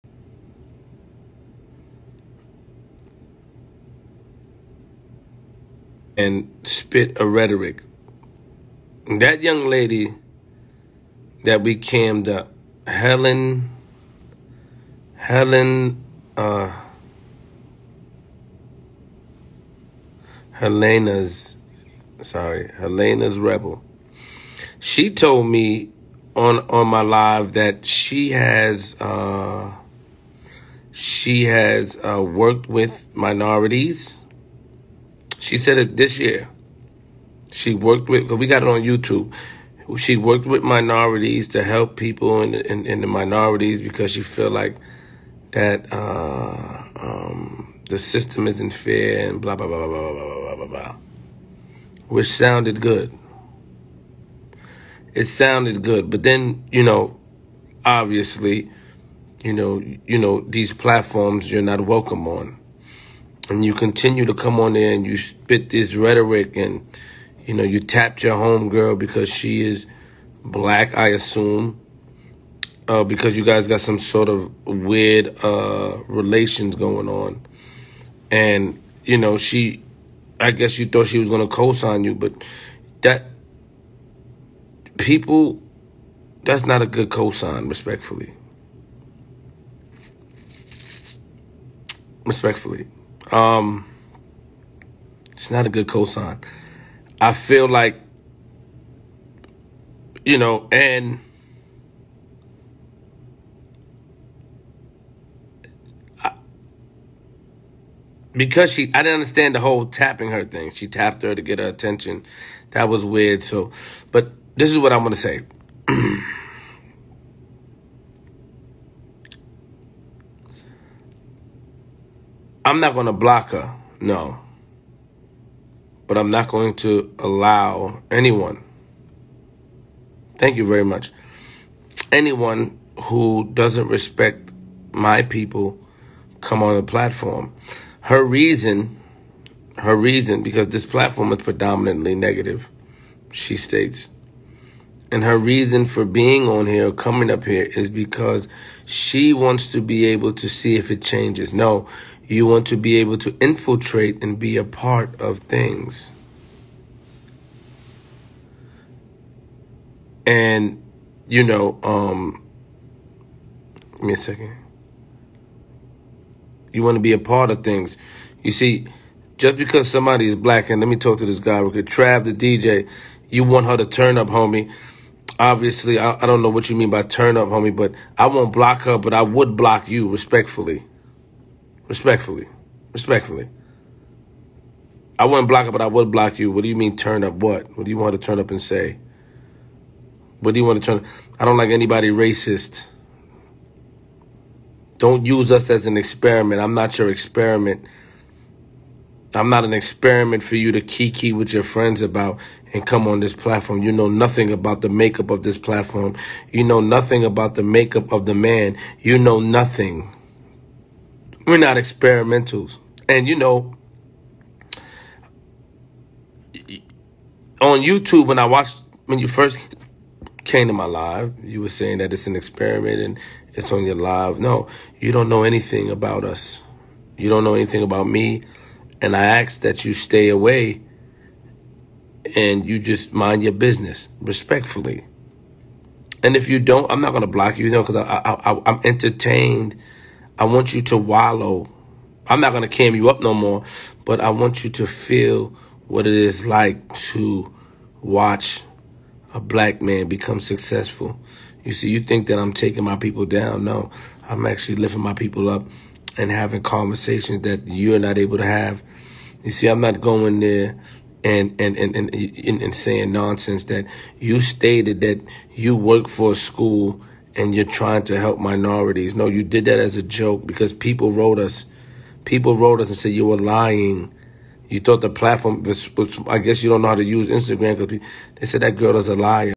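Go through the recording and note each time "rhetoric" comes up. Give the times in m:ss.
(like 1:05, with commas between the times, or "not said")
0:07, 1:05.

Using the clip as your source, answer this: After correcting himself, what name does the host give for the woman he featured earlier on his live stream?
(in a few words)
Helena's Rebel.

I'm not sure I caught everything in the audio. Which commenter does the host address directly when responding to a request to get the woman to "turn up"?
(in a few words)
Trav the DJ.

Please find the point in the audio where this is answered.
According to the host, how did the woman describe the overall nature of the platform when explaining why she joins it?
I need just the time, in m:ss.
2:21.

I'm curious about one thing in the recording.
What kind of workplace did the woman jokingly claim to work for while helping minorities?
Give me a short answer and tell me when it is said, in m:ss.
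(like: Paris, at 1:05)
a school, at 4:26.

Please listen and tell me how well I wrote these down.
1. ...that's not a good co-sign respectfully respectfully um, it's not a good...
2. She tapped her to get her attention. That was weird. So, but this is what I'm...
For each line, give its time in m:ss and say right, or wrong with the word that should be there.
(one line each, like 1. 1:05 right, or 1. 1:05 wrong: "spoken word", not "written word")
1. 1:26 right
2. 1:50 right.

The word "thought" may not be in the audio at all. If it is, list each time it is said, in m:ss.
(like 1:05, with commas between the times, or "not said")
1:20, 4:34.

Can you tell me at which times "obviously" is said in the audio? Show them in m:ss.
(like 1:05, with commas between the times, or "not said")
0:57, 2:55.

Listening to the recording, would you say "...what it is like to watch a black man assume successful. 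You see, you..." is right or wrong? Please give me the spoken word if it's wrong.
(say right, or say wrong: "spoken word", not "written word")
wrong: "become", not "assume".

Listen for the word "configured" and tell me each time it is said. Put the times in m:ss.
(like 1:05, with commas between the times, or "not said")
not said.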